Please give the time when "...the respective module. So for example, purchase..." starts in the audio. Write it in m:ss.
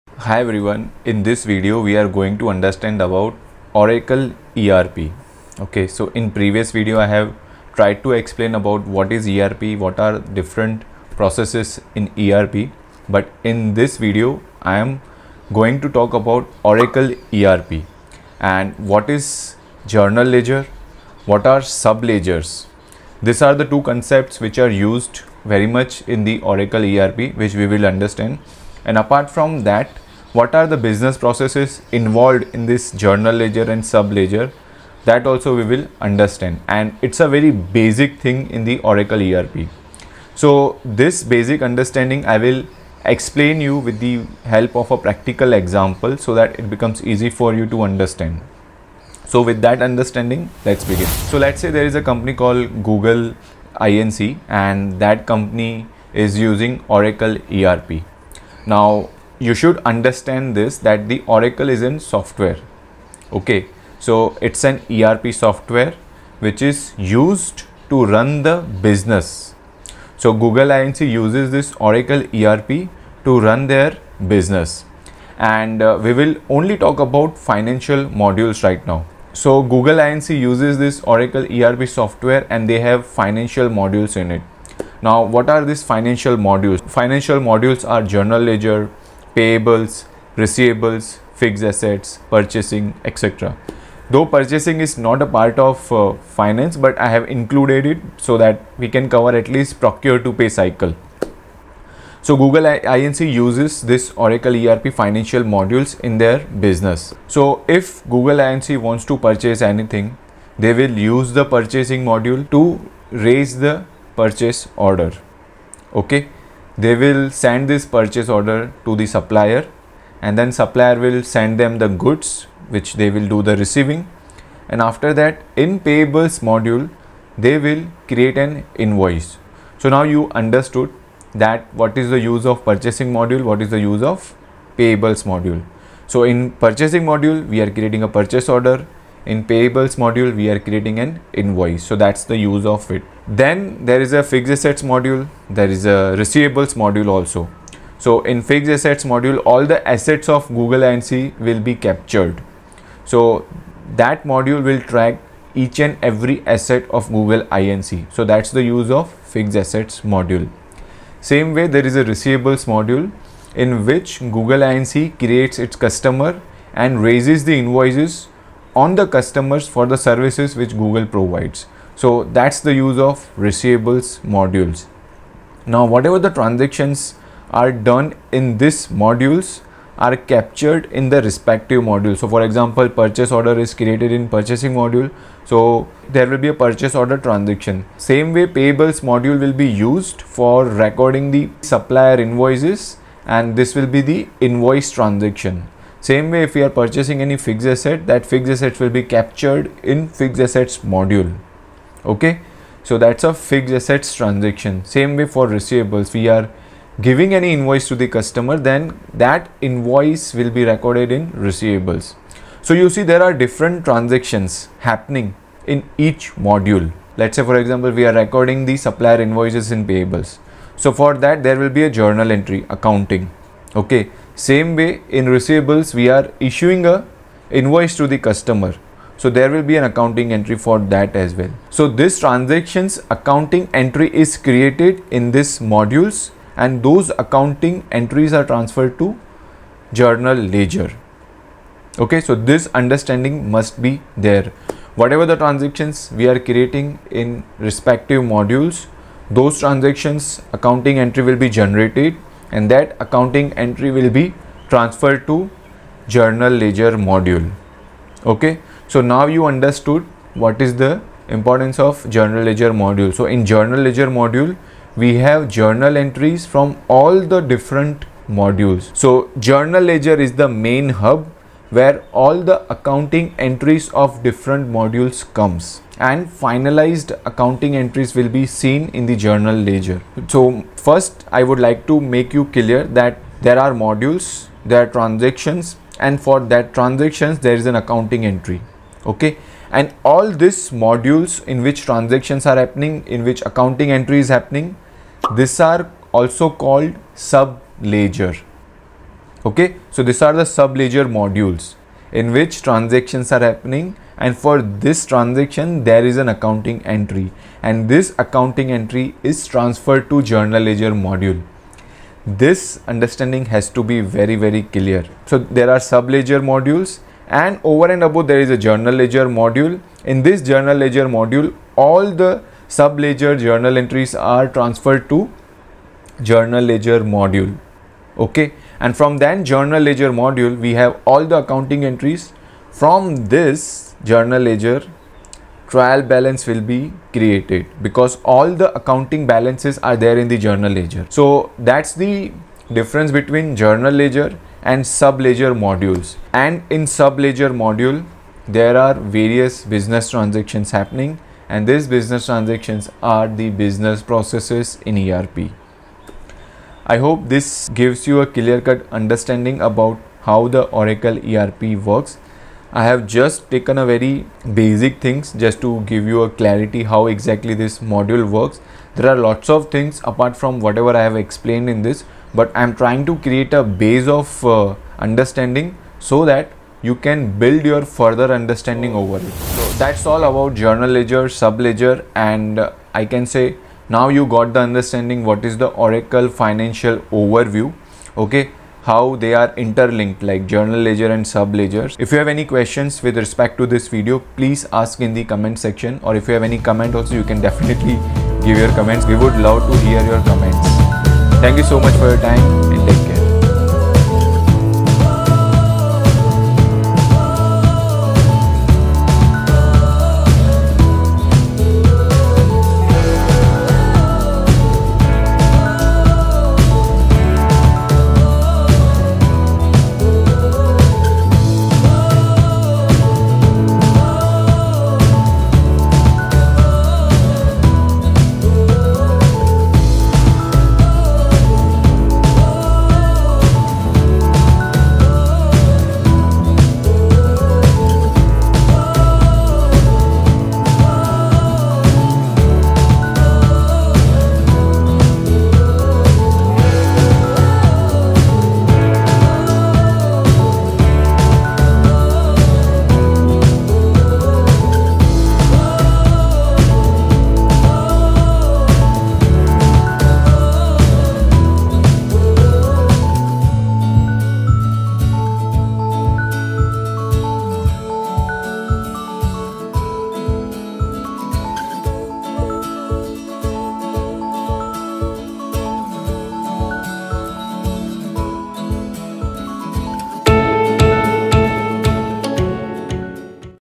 3:01.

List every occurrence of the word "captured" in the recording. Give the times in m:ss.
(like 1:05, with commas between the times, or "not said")
2:31, 3:00, 3:19.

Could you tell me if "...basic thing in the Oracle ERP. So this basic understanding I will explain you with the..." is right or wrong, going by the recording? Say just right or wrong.
right.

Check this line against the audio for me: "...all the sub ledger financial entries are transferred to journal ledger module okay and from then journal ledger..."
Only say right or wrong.
wrong.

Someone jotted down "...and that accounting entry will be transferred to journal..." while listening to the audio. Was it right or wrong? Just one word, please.
right.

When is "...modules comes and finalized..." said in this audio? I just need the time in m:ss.
4:34.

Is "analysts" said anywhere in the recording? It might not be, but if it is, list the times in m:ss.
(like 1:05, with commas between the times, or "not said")
not said.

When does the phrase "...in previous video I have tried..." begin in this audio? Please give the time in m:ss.
0:06.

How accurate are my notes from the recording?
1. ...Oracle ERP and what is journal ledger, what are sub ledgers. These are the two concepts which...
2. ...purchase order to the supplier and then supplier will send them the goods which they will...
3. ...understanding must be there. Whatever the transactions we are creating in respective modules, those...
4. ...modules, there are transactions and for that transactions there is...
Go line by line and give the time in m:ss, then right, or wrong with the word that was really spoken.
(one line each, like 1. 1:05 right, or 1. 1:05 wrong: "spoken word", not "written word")
1. 0:16 right
2. 1:57 right
3. 4:02 right
4. 4:43 right.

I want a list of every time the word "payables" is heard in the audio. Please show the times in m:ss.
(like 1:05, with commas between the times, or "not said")
1:29, 2:05, 2:14, 2:19, 3:08, 3:39.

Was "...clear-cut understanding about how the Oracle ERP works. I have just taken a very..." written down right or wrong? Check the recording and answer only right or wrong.
right.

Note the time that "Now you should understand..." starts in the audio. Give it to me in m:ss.
0:58.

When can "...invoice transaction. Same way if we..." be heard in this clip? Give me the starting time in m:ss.
3:14.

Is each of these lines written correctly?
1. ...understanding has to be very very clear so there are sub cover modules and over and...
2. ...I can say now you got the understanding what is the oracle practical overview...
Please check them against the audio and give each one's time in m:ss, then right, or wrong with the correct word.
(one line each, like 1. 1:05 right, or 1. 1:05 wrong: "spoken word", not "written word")
1. 5:12 wrong: "ledger", not "cover"
2. 6:22 wrong: "financial", not "practical".